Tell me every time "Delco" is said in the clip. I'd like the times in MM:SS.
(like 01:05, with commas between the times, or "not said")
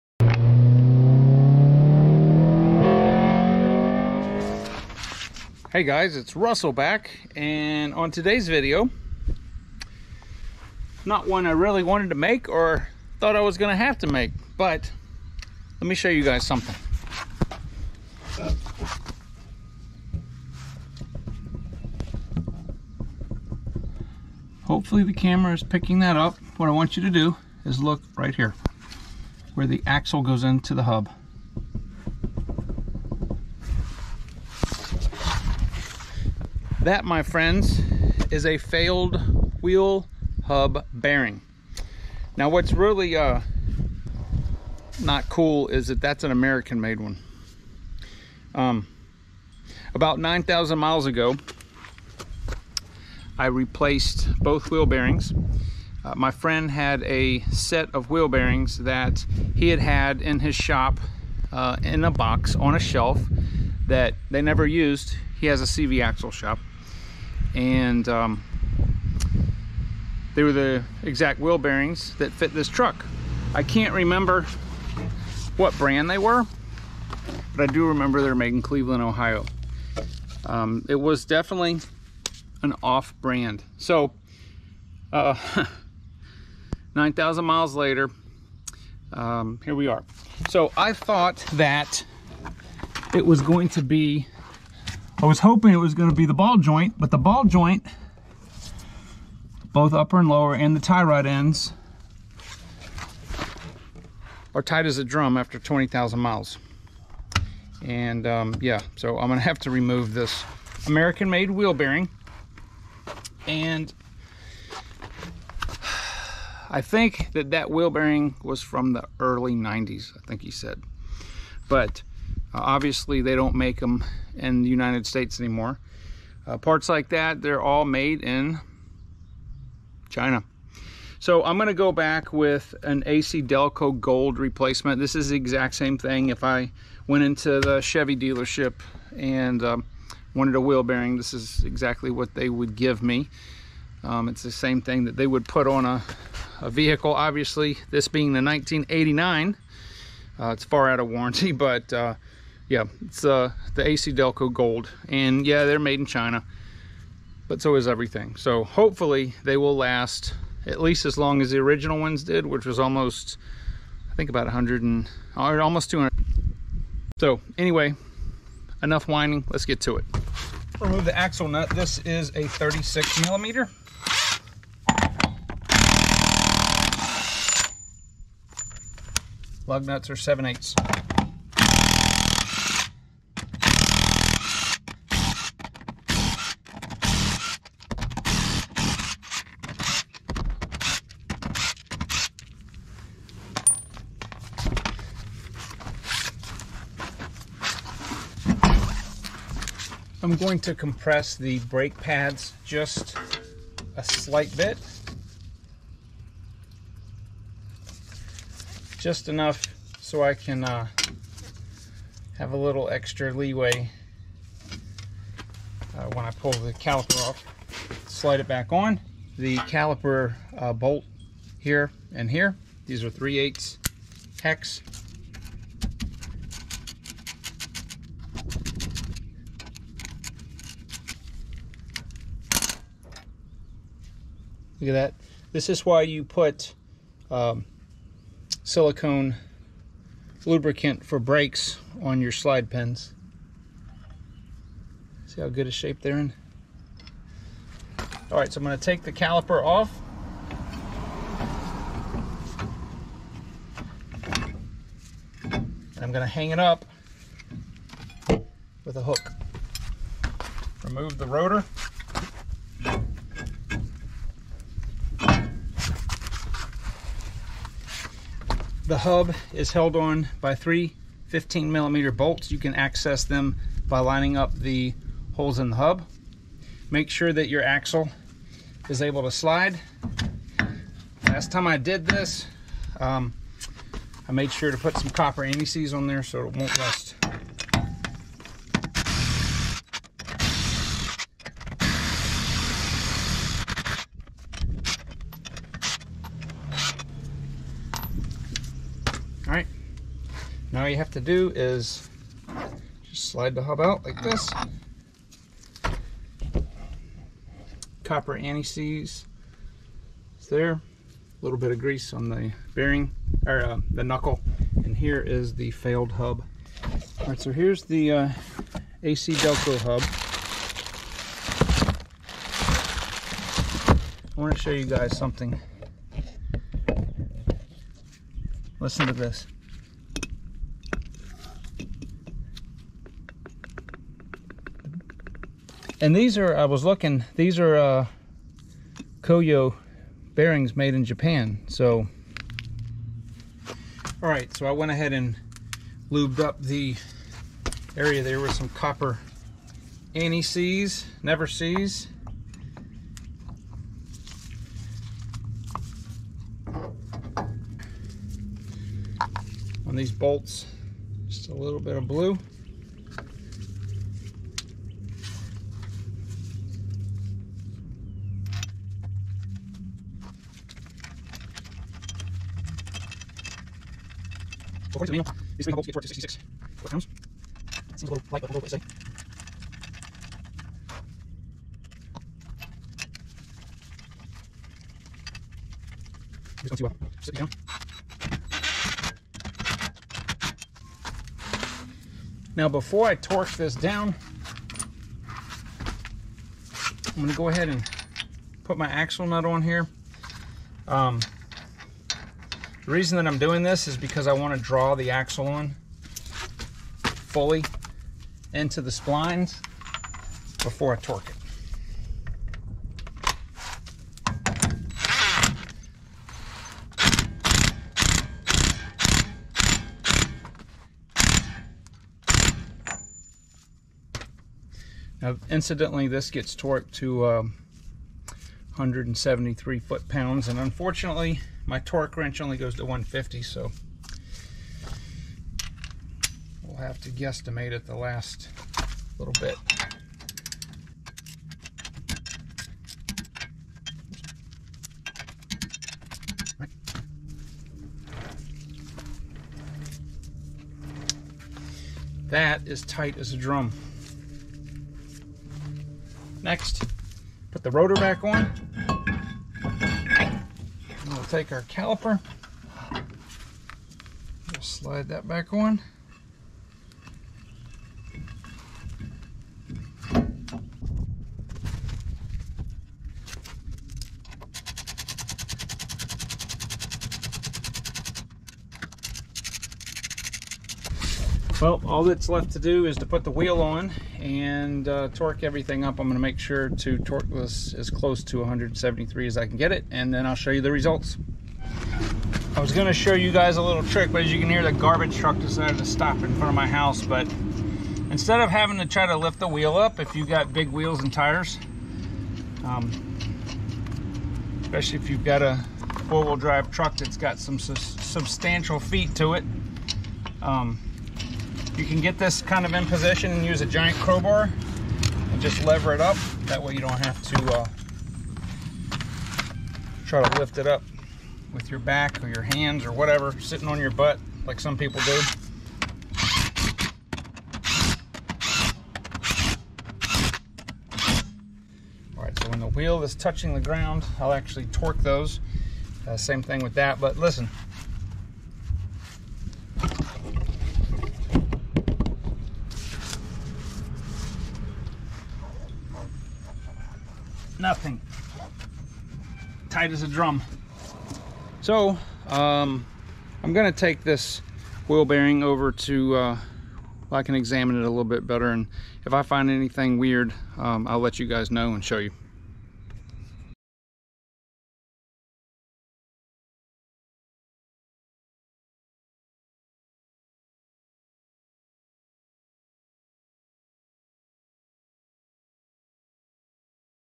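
02:13, 02:34, 05:19.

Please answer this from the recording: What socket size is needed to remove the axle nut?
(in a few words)
36 millimeter.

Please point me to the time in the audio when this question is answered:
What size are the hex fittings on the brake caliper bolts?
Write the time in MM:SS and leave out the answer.
03:43.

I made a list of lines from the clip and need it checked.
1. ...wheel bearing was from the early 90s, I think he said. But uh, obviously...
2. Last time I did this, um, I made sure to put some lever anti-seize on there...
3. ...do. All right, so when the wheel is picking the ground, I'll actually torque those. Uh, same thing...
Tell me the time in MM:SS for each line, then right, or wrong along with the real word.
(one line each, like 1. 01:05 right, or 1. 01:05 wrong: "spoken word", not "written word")
1. 01:57 right
2. 04:41 wrong: "copper", not "lever"
3. 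08:45 wrong: "touching", not "picking".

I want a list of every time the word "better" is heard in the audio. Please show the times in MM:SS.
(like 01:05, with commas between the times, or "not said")
09:18.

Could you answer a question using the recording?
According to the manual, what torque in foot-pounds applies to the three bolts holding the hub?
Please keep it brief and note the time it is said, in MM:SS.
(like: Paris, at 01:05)
66, at 06:16.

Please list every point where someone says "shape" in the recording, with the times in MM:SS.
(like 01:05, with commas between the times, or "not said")
04:05.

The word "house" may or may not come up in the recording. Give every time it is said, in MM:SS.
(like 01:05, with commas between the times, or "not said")
08:16.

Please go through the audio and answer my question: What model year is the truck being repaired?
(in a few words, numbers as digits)
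1989.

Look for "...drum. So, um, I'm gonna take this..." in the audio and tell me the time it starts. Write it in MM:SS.
09:10.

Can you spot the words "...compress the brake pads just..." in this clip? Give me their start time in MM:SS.
03:20.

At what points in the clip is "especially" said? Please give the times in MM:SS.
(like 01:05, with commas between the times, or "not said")
08:24.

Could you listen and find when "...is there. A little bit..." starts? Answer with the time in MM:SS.
05:10.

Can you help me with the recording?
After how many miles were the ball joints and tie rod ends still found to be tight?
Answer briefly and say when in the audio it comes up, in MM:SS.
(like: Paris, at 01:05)
20,000, at 01:45.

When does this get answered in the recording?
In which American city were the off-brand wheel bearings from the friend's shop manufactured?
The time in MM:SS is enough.
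01:18.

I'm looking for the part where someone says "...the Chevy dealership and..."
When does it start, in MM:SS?
02:17.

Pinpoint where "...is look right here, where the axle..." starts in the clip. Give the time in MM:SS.
00:27.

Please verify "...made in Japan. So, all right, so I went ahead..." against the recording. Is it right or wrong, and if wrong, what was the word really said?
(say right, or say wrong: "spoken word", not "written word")
right.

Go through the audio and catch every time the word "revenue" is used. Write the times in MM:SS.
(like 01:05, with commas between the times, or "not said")
not said.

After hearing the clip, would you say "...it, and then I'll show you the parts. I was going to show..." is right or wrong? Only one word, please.
wrong.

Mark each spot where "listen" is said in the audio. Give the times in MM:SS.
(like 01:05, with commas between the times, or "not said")
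05:28, 08:57.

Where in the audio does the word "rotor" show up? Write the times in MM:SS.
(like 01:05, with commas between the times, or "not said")
04:21, 07:37.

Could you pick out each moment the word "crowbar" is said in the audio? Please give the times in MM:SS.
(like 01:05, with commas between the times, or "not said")
08:33.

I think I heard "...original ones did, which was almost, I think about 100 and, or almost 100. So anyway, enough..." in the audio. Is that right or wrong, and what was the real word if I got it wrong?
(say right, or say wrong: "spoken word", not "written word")
wrong: "200", not "100".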